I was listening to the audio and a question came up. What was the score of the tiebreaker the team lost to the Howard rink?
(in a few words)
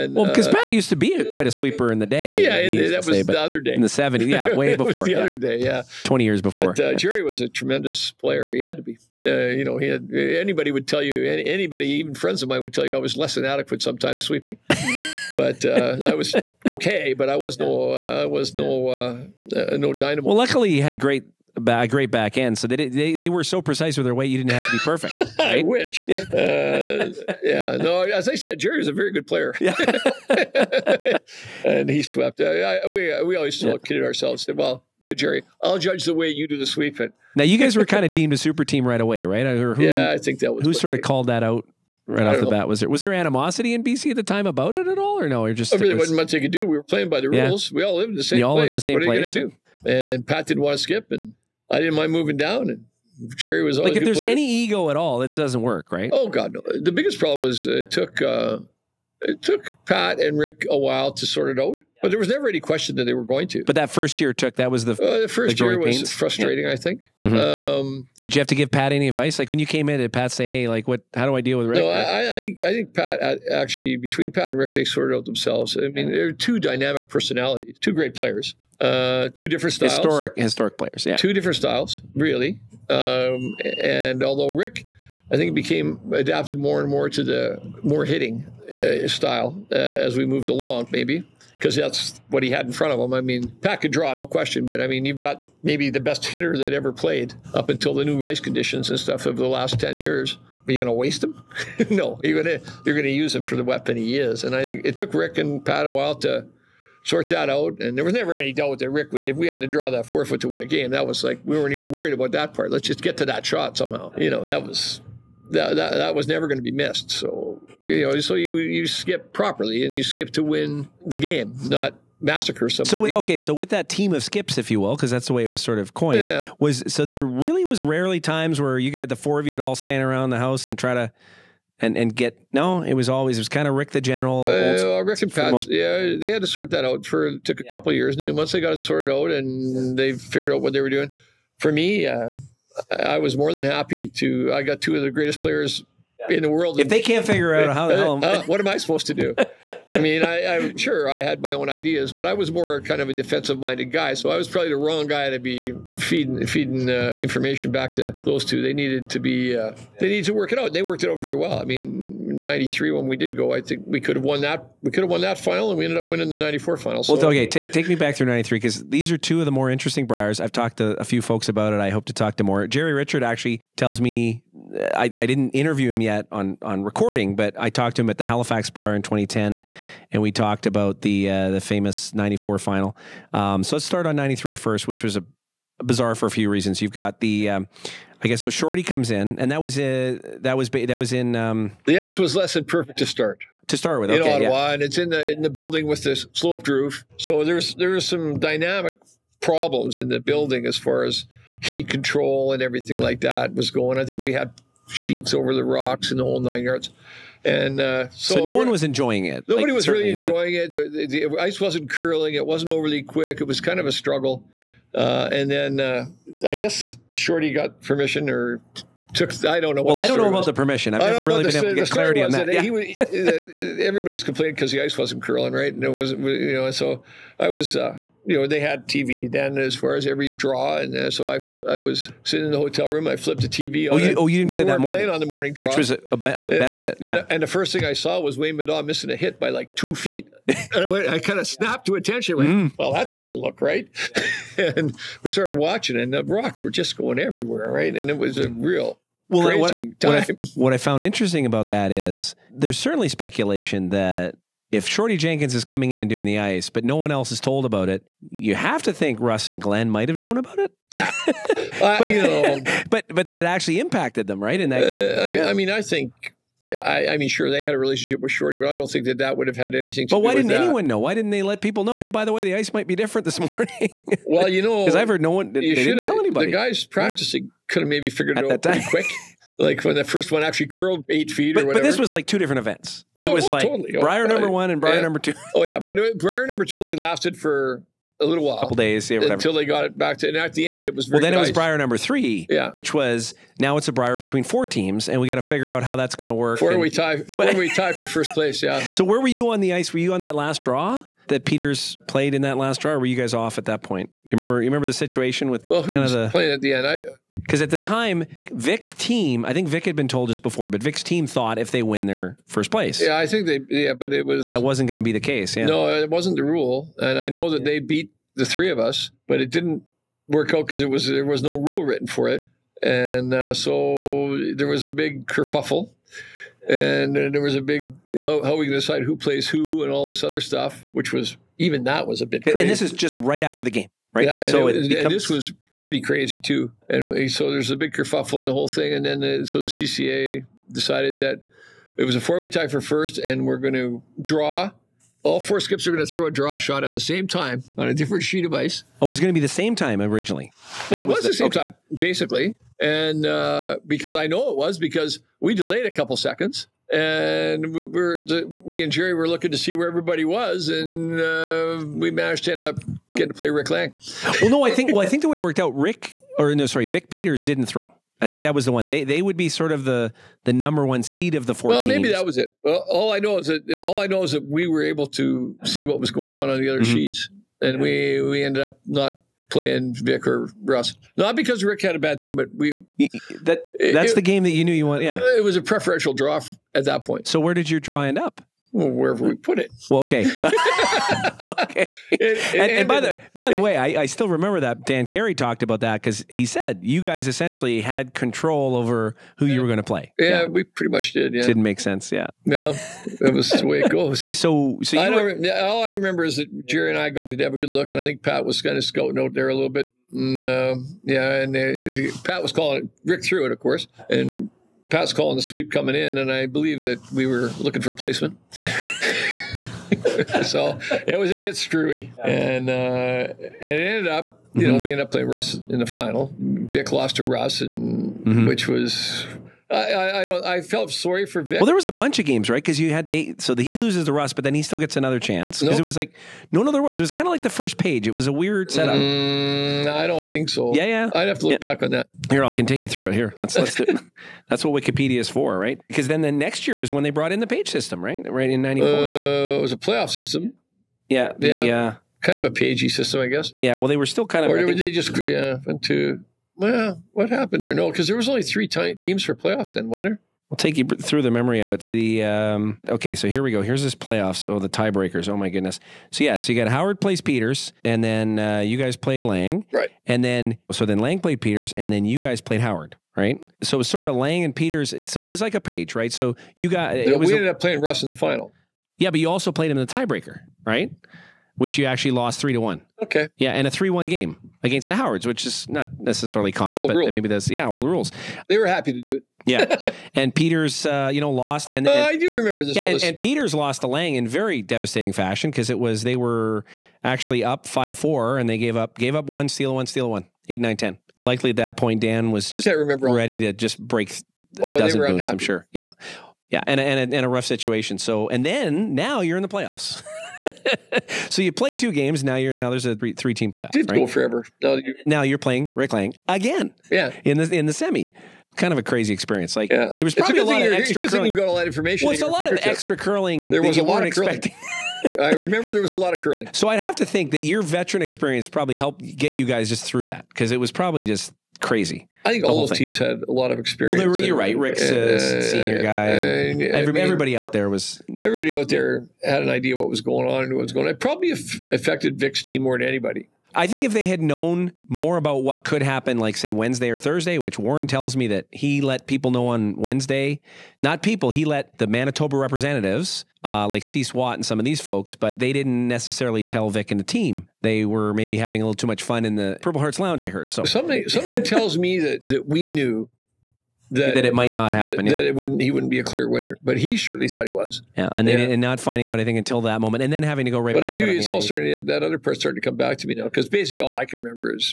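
3-1.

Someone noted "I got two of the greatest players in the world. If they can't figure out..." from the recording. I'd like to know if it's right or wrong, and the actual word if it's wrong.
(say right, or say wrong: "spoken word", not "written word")
right.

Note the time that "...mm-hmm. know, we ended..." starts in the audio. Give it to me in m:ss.
7:04.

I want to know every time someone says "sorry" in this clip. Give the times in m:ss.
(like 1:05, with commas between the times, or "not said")
6:06, 7:10.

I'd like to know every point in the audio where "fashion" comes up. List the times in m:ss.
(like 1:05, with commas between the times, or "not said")
8:15.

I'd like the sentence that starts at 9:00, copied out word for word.
It probably affected Vic's team more than anybody.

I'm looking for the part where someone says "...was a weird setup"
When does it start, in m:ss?
7:18.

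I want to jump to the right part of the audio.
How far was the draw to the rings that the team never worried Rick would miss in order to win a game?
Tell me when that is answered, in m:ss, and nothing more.
1:50.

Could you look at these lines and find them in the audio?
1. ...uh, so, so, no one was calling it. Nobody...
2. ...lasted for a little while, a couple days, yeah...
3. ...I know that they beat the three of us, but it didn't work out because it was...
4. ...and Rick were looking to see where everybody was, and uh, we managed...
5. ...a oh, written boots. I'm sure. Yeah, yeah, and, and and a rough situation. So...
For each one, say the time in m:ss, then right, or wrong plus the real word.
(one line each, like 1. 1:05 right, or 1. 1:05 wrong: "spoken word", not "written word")
1. 3:27 wrong: "enjoying", not "calling"
2. 4:46 right
3. 5:17 right
4. 5:58 wrong: "Gerry", not "Rick"
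5. 8:24 wrong: "dozen", not "written".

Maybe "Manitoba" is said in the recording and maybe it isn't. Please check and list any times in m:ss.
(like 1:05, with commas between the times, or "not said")
9:11.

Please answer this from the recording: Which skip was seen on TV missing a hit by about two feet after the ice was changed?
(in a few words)
Wayne Middaugh.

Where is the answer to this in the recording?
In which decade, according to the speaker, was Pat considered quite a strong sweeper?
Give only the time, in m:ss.
0:03.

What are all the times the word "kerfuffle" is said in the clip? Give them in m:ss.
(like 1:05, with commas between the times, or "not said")
5:25, 5:37.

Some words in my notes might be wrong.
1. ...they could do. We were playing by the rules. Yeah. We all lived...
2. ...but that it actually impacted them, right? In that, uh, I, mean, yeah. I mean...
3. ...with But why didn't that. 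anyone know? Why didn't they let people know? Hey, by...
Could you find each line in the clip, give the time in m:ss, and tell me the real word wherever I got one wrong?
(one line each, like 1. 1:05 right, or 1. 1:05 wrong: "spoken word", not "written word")
1. 0:46 right
2. 4:23 right
3. 4:30 right.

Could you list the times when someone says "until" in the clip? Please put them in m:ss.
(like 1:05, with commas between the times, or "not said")
1:37, 4:49, 9:29.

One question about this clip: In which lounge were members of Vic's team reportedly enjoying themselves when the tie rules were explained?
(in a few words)
Purple Hearts Lounge.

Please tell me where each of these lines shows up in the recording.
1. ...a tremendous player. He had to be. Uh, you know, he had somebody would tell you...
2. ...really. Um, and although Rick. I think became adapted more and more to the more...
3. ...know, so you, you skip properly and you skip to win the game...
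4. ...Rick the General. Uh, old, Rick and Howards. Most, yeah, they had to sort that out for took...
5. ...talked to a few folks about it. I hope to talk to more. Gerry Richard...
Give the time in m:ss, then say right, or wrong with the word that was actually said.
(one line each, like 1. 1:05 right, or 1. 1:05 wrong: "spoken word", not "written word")
1. 0:07 wrong: "anybody", not "somebody"
2. 1:22 right
3. 1:58 right
4. 2:13 wrong: "Pat", not "Howards"
5. 2:50 right.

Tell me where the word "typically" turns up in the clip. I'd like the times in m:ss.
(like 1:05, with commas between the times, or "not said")
not said.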